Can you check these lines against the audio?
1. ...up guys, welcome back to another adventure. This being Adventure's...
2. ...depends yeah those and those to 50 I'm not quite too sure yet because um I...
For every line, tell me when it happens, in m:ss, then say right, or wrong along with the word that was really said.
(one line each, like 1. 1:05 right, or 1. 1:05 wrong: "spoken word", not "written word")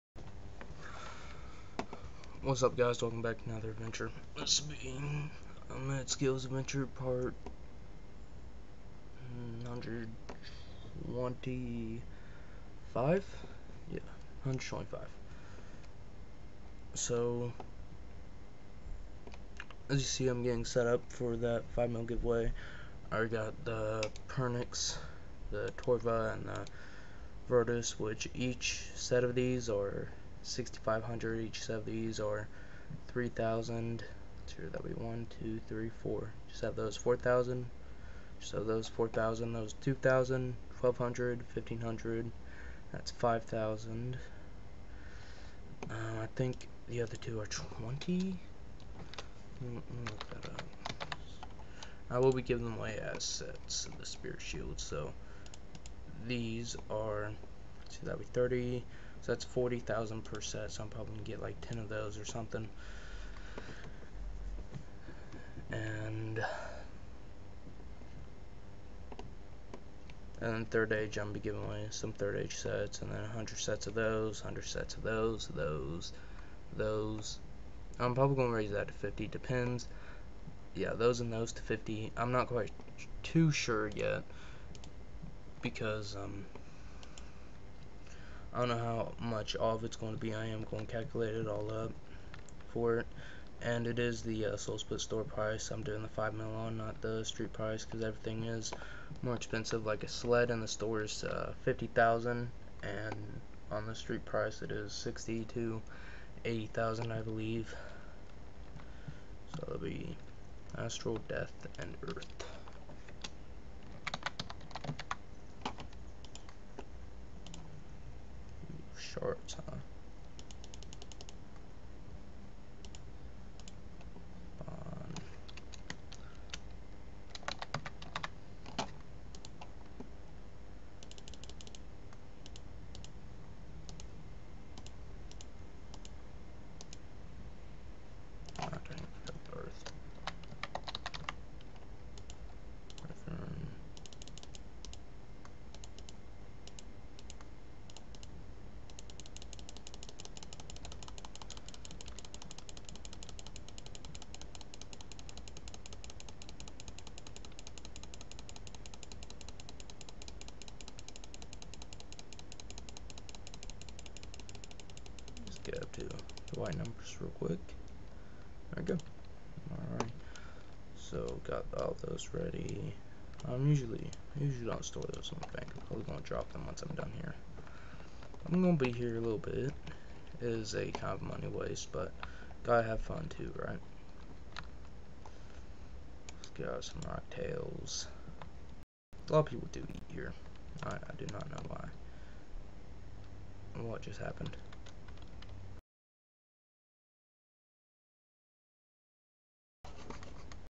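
1. 0:02 wrong: "Omittedskill", not "Adventure"
2. 1:19 right.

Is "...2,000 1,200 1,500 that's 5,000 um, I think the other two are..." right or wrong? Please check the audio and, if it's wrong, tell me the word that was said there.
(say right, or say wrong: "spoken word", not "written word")
right.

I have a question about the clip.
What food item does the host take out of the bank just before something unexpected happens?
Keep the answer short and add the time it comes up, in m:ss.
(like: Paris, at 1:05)
rock tails, at 3:07.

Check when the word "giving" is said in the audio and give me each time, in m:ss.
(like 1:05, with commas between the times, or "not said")
0:52, 1:11.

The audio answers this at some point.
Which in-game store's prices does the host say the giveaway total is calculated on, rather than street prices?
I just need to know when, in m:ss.
1:34.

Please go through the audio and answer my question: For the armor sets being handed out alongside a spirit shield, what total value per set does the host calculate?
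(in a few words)
40,000.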